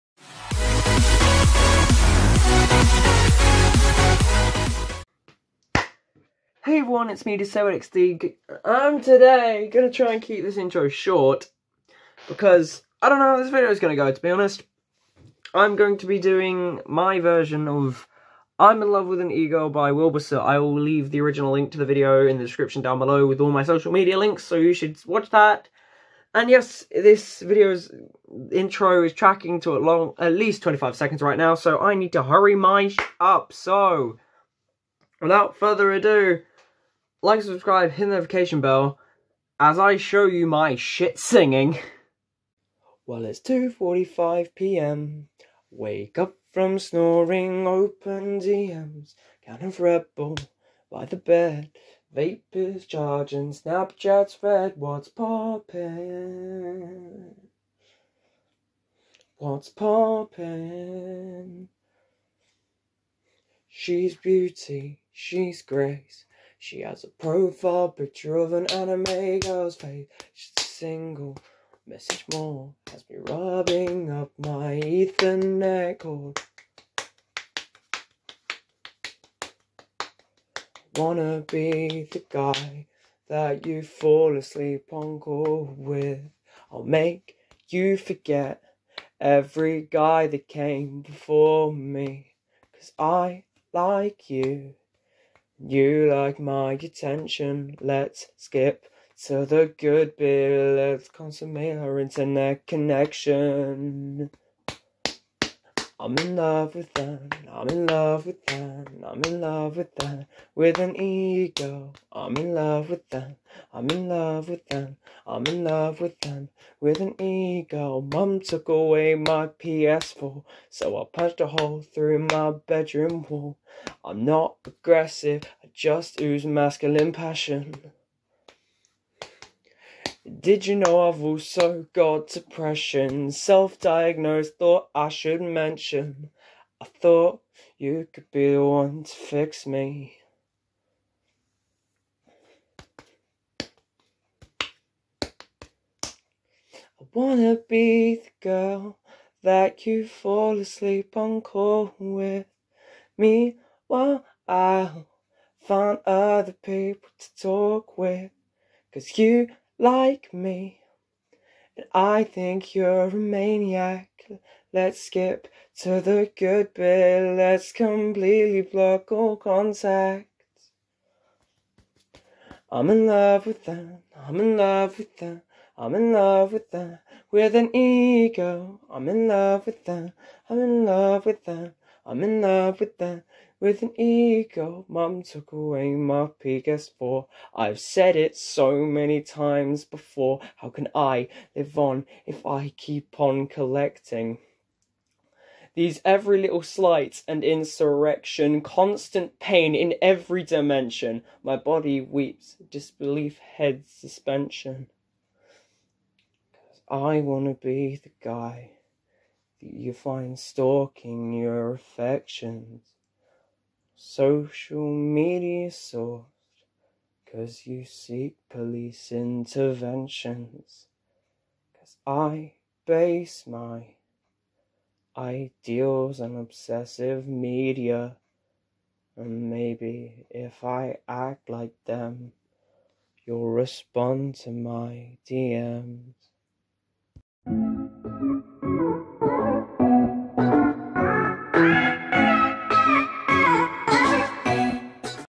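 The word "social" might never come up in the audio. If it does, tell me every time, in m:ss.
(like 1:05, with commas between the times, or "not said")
0:23, 3:34.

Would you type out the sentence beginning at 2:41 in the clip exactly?
And I think you're a maniac.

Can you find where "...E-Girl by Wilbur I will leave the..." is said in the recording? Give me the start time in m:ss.
0:19.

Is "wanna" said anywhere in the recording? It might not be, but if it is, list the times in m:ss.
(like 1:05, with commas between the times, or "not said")
1:20, 2:27, 3:27.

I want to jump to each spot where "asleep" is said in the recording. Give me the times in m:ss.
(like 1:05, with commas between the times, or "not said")
1:24, 2:30.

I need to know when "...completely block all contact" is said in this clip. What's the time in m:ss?
2:47.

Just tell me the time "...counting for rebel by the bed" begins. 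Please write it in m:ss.
0:49.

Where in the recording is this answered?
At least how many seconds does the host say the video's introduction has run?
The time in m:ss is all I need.
0:30.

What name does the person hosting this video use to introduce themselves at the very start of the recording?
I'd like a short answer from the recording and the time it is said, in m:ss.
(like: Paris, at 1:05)
DisabledXD, at 0:07.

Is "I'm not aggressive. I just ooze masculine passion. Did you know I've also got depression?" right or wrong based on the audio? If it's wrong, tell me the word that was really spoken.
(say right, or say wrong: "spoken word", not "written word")
right.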